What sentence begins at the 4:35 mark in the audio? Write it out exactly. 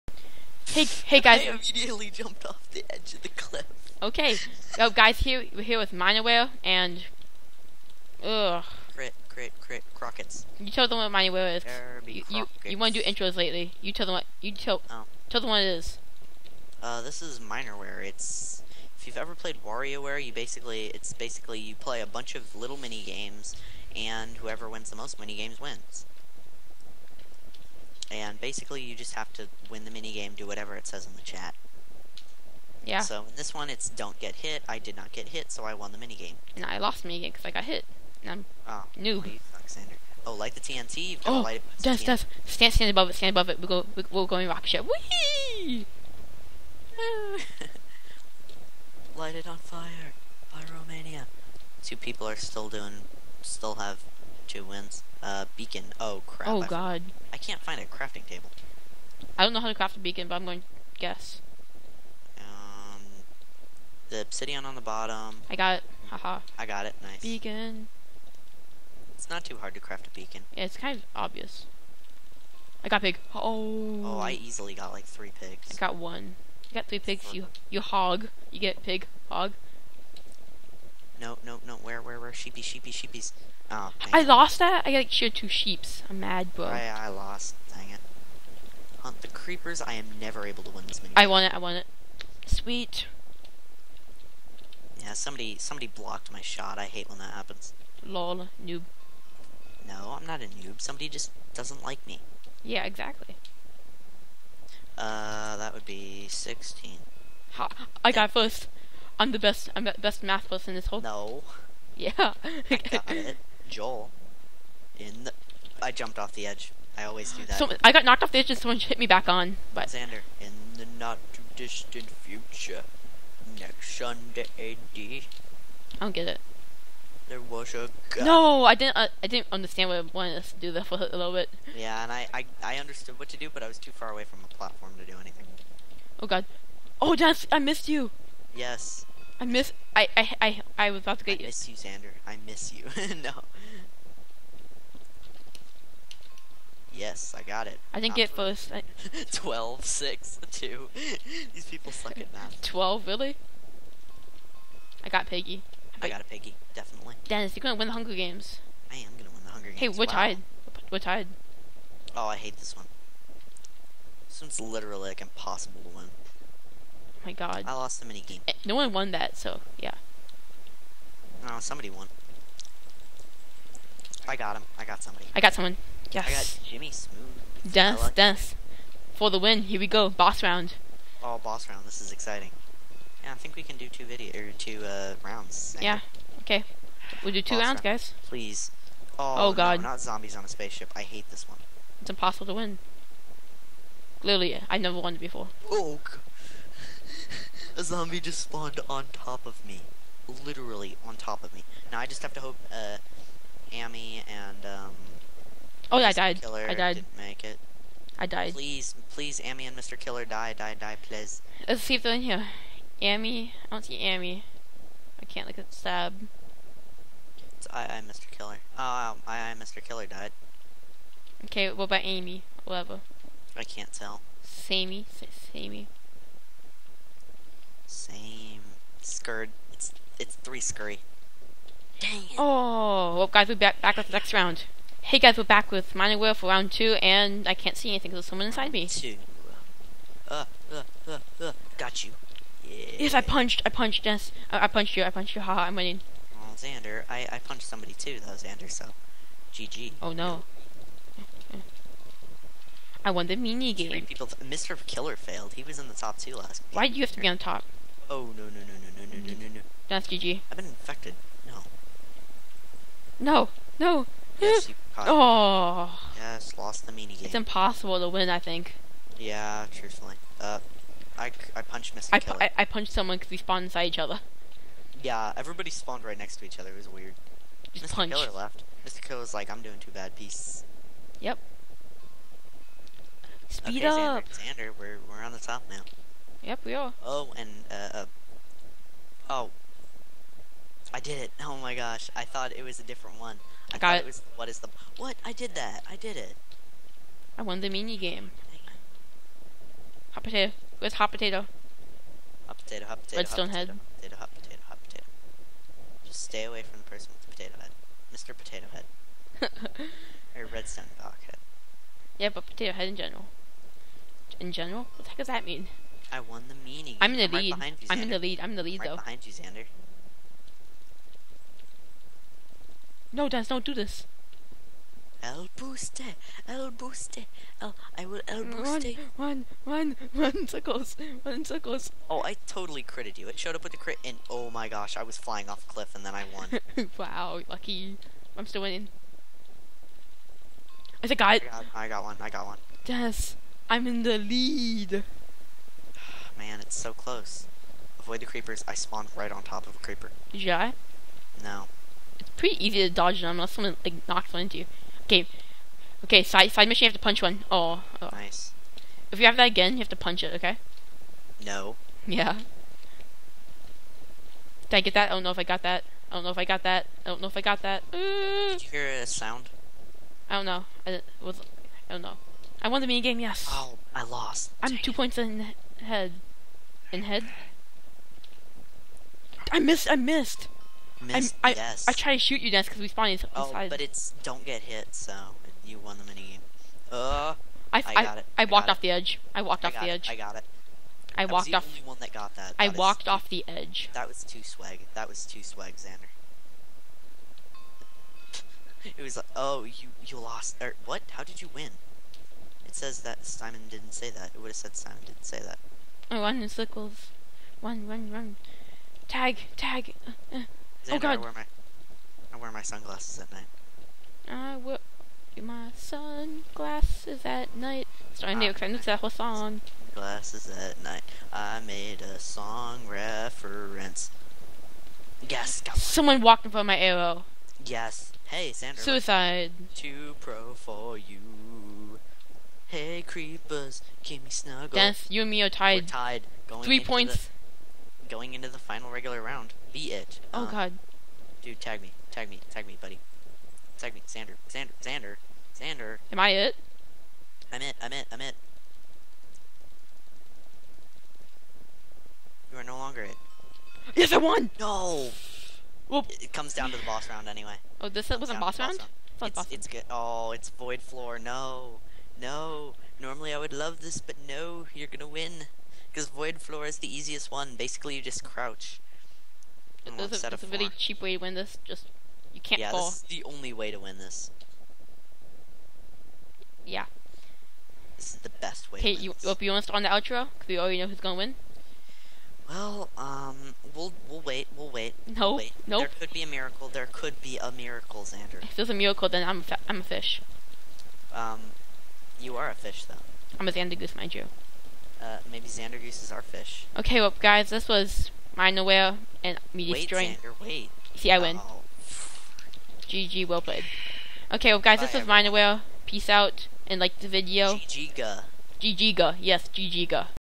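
Yeah, everybody spawned right next to each other.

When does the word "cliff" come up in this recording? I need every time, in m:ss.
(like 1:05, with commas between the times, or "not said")
0:03, 5:35.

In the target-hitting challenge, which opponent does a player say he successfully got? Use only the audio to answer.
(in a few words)
Jimmy Smooth.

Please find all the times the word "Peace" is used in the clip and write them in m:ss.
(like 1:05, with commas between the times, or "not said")
4:40, 8:25.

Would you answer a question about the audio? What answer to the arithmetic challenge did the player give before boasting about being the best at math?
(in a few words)
16.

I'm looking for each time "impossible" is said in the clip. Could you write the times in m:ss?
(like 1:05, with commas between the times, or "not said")
2:45, 3:12, 4:27.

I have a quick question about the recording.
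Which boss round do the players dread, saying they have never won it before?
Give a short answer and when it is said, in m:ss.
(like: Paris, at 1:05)
zombies on a spaceship, at 3:10.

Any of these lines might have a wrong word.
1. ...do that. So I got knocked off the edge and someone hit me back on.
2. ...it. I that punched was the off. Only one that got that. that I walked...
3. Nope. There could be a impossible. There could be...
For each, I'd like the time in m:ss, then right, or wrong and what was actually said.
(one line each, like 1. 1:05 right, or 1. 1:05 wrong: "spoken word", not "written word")
1. 1:57 right
2. 6:30 wrong: "walked", not "punched"
3. 8:05 wrong: "miracle", not "impossible".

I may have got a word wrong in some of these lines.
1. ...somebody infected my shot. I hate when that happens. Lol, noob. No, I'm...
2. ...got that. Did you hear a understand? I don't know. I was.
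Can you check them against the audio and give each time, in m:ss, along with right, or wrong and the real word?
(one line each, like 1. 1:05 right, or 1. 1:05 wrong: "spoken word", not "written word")
1. 1:35 wrong: "blocked", not "infected"
2. 6:07 wrong: "sound", not "understand".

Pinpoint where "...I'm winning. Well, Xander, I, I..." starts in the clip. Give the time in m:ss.
4:05.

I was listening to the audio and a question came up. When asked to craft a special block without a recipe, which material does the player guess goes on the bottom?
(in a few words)
obsidian.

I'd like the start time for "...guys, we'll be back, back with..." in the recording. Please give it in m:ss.
3:53.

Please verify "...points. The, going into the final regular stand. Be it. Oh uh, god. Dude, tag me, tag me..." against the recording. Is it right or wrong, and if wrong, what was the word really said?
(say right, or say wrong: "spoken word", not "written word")
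wrong: "round", not "stand".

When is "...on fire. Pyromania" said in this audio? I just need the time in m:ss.
0:49.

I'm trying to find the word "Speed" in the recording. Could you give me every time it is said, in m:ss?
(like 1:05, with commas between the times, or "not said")
4:43.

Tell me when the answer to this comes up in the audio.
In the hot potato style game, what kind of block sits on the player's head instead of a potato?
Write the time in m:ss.
5:10.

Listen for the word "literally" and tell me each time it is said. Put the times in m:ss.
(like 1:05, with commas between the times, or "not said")
2:44, 3:14, 3:20.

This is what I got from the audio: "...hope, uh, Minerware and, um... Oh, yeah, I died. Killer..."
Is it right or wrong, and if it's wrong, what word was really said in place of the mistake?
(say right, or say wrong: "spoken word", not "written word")
wrong: "Amy", not "Minerware".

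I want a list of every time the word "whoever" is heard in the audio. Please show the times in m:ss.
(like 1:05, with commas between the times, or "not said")
0:24.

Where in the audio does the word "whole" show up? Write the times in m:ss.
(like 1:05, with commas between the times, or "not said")
1:50, 6:59.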